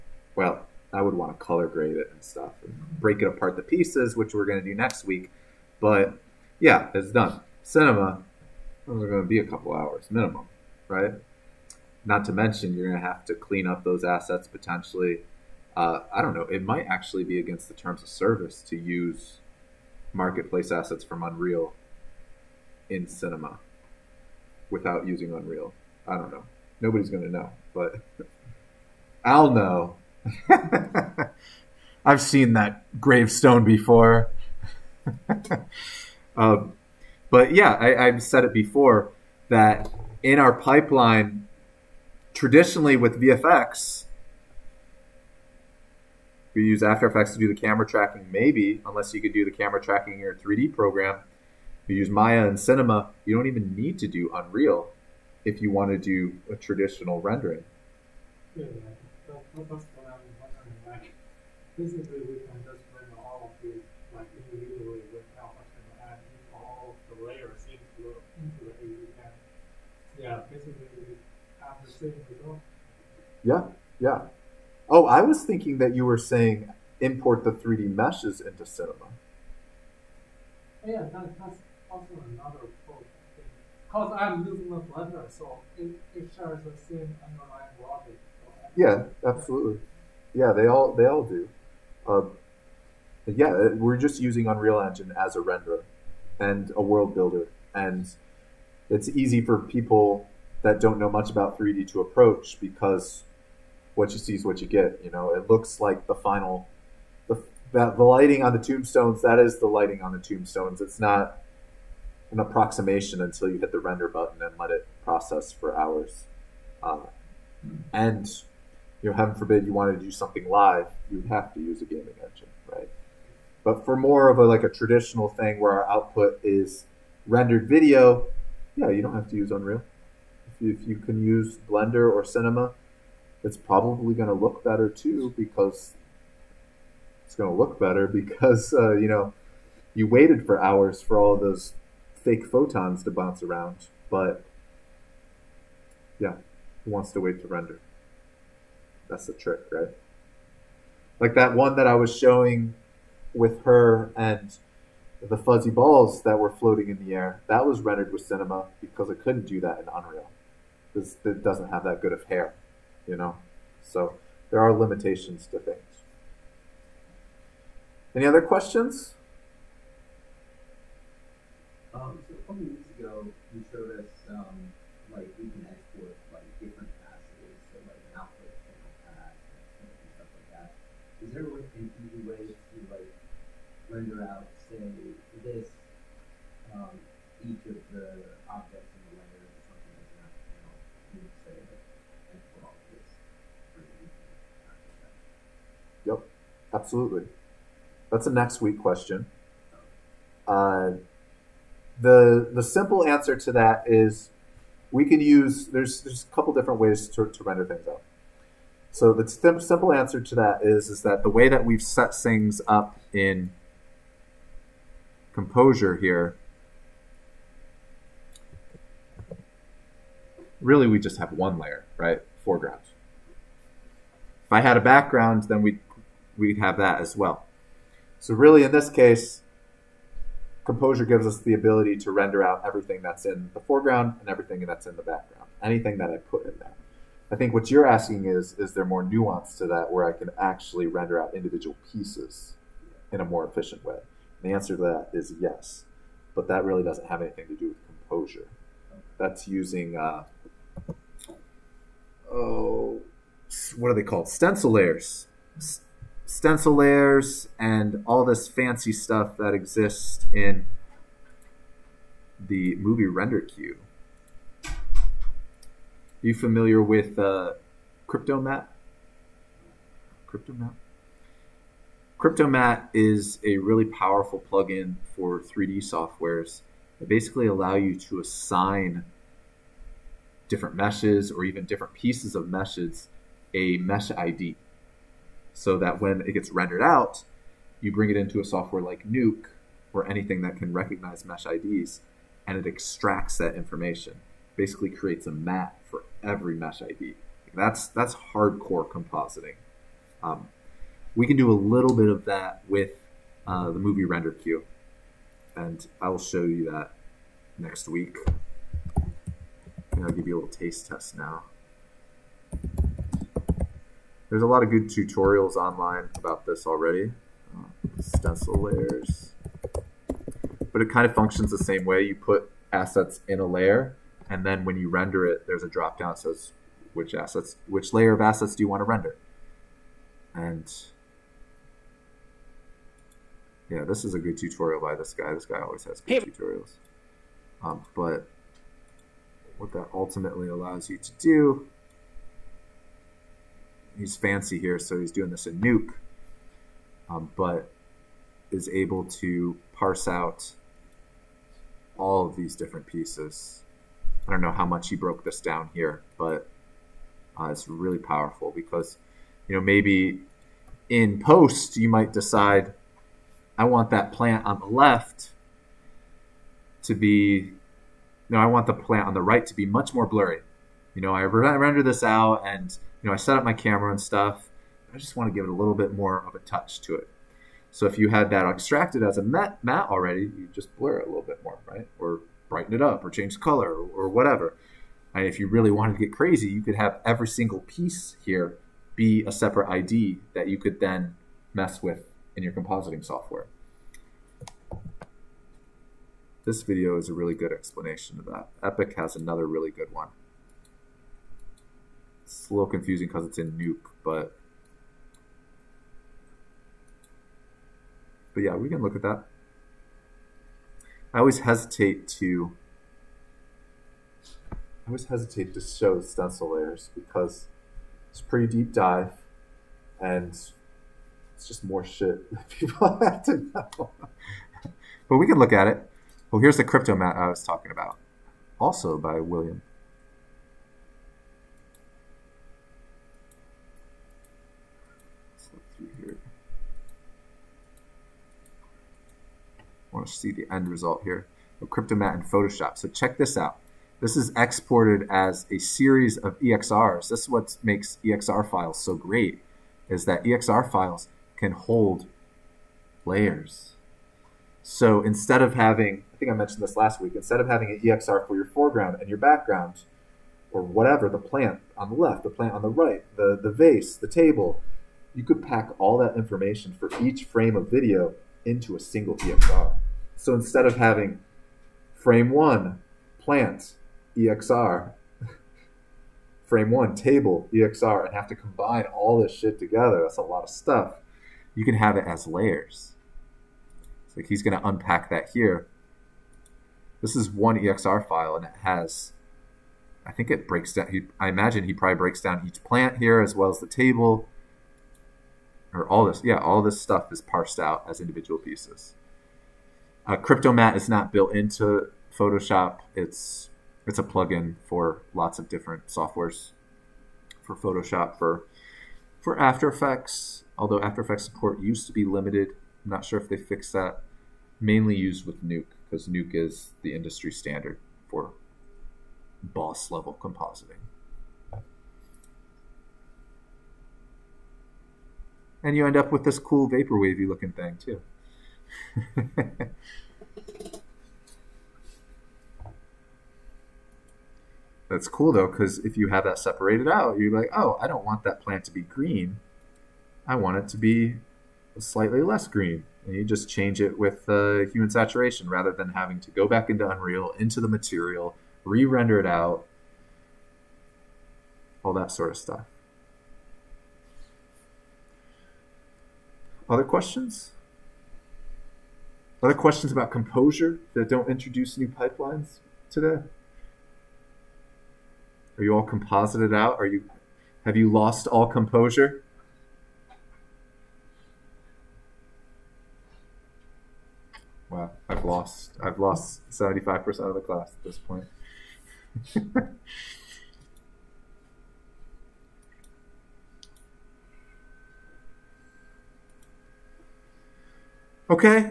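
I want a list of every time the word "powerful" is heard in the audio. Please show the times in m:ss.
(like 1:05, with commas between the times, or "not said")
4:33, 5:57.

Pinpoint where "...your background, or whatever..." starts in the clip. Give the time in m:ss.
7:39.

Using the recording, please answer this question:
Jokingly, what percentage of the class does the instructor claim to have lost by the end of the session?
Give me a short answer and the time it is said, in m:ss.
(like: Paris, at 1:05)
75%, at 9:36.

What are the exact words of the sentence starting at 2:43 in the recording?
So there are limitations to things.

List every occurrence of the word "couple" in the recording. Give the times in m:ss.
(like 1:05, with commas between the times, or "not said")
0:09, 2:52, 3:26.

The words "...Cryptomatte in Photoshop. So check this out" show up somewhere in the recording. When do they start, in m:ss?
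7:21.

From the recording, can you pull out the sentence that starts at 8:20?
Uh, Cryptomatte is not built into Photoshop.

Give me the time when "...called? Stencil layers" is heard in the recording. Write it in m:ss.
4:14.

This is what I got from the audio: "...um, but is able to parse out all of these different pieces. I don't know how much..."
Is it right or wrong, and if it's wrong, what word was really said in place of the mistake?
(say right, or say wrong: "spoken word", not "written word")
right.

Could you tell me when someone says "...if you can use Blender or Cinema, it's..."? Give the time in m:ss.
2:10.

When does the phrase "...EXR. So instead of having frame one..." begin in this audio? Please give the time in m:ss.
7:49.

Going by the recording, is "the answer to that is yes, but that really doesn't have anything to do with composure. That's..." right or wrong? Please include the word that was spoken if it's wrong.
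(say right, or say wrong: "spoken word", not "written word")
right.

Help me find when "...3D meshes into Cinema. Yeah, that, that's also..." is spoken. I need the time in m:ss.
1:17.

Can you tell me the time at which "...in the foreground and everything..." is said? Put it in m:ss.
3:53.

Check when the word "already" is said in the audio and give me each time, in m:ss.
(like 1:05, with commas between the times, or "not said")
5:16, 6:19.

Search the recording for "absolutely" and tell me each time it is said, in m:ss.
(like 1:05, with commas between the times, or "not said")
1:29, 3:16.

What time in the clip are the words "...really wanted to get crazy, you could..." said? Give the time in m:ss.
6:25.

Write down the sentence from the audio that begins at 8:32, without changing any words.
I'm not sure if they fixed that.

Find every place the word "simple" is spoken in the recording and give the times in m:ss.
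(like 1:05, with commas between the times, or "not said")
3:22, 3:29.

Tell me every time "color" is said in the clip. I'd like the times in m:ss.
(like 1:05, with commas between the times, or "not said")
0:01, 6:23.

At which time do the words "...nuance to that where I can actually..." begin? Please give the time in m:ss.
3:59.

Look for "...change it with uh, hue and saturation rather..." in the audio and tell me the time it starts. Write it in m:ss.
9:03.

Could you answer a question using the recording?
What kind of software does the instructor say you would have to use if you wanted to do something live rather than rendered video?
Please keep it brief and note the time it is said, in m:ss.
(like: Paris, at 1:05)
gaming engine, at 2:01.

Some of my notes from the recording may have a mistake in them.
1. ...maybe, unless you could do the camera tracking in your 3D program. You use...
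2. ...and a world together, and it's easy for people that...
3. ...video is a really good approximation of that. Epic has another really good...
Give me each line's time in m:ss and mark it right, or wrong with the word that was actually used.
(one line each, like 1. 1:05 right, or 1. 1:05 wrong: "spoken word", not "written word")
1. 0:48 right
2. 1:36 wrong: "builder", not "together"
3. 6:36 wrong: "explanation", not "approximation".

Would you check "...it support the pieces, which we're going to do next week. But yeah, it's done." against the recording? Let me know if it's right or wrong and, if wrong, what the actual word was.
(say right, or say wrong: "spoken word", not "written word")
wrong: "apart", not "support".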